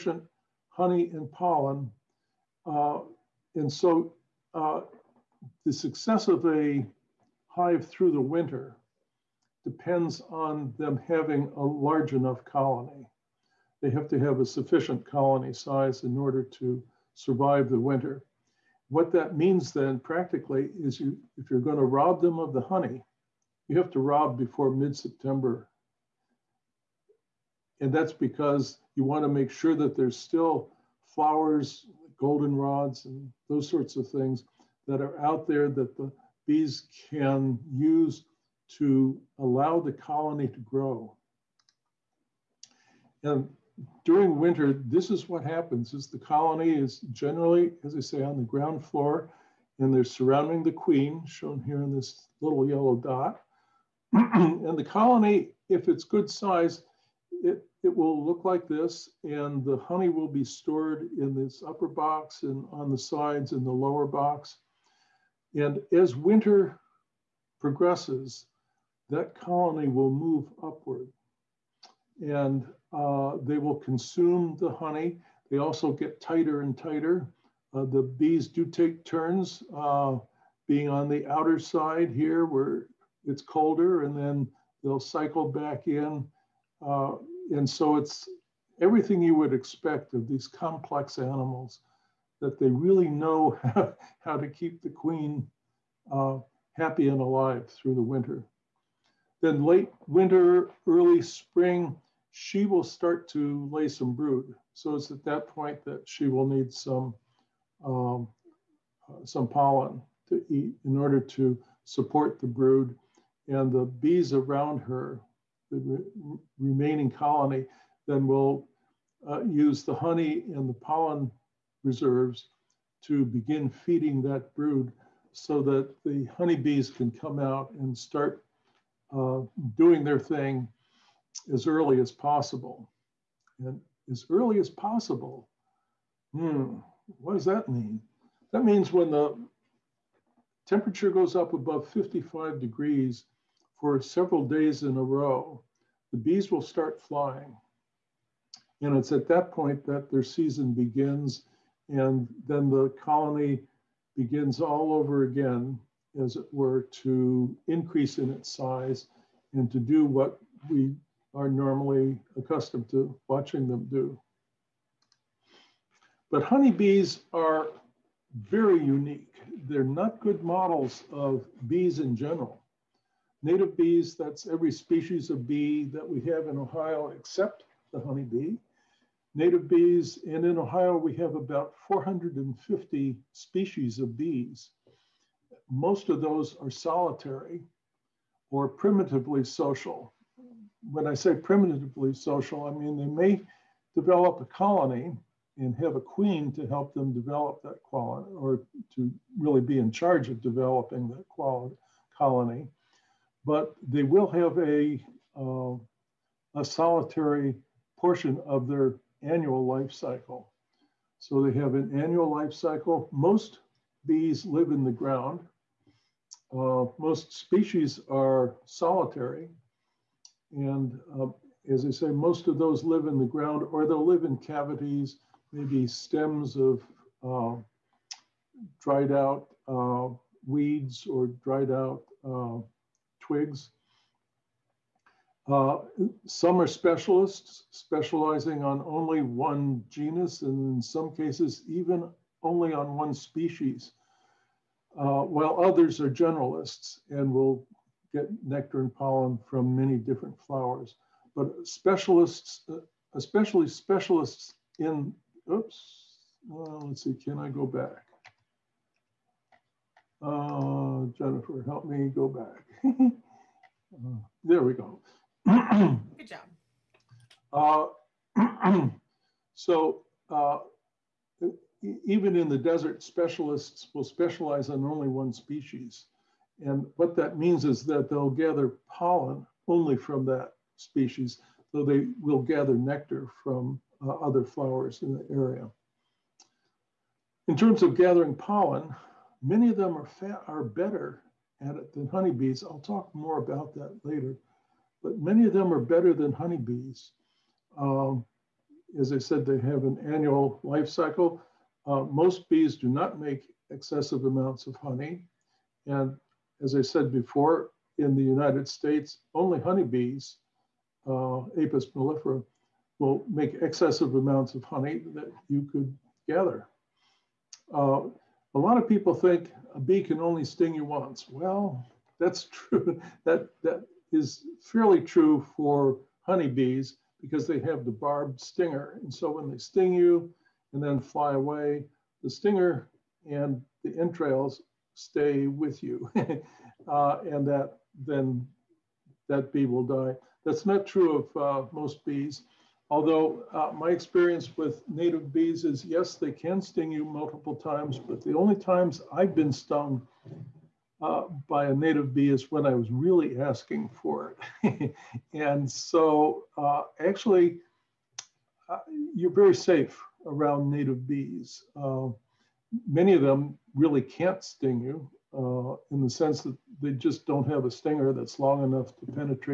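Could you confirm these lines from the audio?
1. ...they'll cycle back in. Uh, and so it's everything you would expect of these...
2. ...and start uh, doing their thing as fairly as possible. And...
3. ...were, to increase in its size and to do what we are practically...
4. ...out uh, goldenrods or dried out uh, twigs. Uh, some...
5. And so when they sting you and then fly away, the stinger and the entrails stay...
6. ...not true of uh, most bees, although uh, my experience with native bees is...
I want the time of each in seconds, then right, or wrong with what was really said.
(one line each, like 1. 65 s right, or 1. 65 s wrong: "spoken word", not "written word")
1. 84 s right
2. 127 s wrong: "early", not "fairly"
3. 156 s wrong: "normally", not "practically"
4. 229 s wrong: "weeds", not "goldenrods"
5. 329 s right
6. 340 s right.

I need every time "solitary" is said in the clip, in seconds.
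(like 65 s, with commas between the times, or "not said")
186 s, 206 s, 218 s.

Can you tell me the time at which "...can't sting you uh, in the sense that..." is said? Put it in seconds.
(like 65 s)
364 s.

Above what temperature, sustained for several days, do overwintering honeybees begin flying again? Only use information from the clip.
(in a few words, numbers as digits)
55 degrees.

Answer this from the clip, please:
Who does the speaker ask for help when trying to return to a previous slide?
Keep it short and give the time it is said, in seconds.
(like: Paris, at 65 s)
Jennifer, at 261 s.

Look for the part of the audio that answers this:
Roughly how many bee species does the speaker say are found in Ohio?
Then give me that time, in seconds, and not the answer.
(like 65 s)
181 s.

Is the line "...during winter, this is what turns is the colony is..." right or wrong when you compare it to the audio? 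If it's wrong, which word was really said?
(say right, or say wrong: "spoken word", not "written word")
wrong: "happens", not "turns".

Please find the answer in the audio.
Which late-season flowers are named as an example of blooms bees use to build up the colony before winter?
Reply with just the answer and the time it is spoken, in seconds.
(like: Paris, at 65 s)
goldenrods, at 32 s.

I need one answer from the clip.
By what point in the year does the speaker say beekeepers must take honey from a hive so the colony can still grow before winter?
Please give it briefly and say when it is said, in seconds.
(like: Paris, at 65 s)
mid-September, at 24 s.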